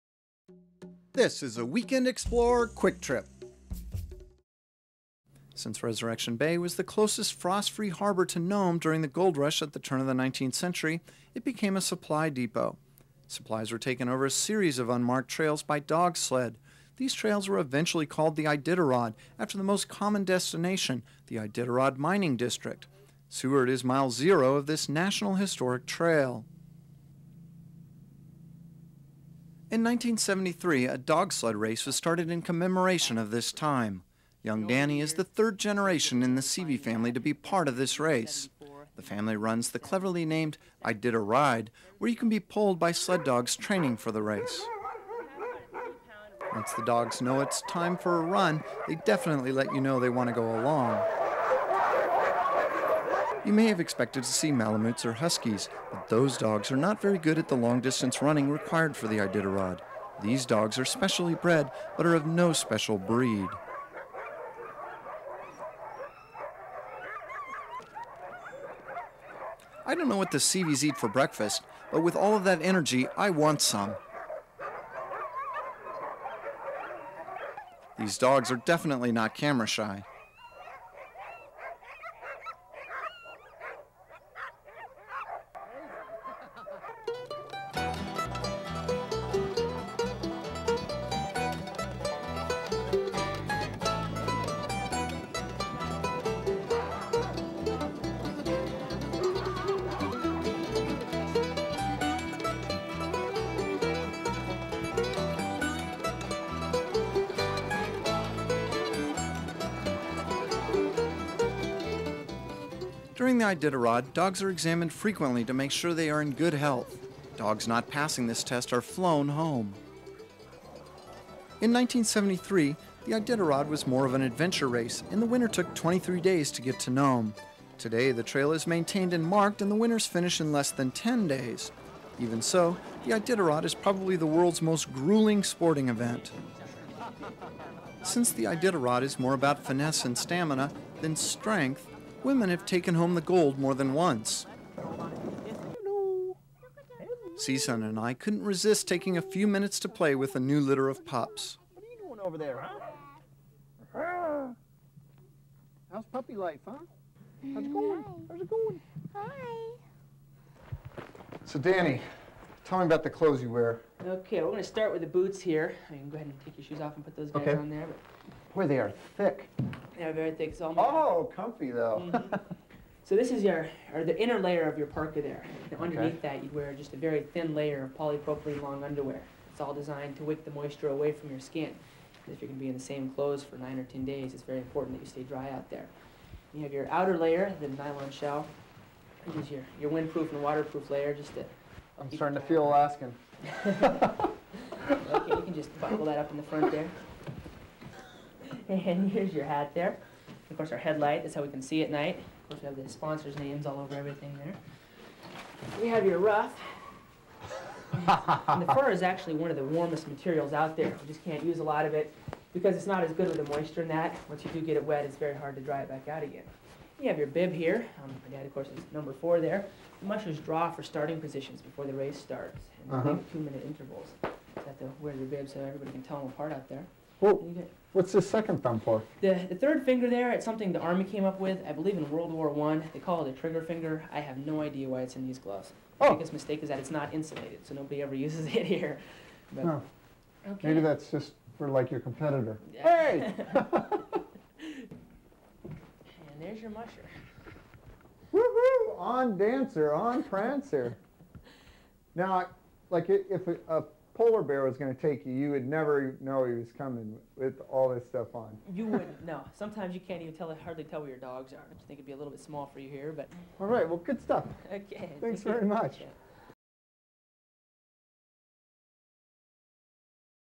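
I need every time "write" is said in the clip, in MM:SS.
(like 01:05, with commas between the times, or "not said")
not said.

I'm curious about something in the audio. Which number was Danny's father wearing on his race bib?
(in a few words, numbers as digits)
4.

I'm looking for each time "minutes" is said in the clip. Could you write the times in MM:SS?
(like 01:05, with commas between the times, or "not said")
02:29, 03:43.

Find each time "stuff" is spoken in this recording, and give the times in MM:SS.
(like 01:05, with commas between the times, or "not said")
04:18, 04:24.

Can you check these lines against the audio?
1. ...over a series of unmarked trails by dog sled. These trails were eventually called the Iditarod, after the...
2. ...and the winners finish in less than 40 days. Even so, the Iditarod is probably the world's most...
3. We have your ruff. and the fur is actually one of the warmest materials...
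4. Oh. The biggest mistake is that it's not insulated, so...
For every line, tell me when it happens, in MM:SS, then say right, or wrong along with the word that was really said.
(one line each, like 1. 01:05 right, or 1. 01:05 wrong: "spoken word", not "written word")
1. 00:14 right
2. 02:09 wrong: "10", not "40"
3. 03:25 right
4. 03:56 right.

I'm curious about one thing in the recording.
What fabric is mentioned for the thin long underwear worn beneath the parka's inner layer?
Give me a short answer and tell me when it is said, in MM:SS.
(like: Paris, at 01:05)
polypropylene, at 02:57.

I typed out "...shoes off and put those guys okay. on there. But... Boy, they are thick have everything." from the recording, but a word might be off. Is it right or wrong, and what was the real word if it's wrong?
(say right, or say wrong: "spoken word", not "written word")
right.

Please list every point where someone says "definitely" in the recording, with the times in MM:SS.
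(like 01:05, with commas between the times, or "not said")
00:49, 01:18.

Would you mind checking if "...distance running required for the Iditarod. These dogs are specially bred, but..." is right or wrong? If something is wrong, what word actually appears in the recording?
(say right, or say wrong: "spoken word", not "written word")
right.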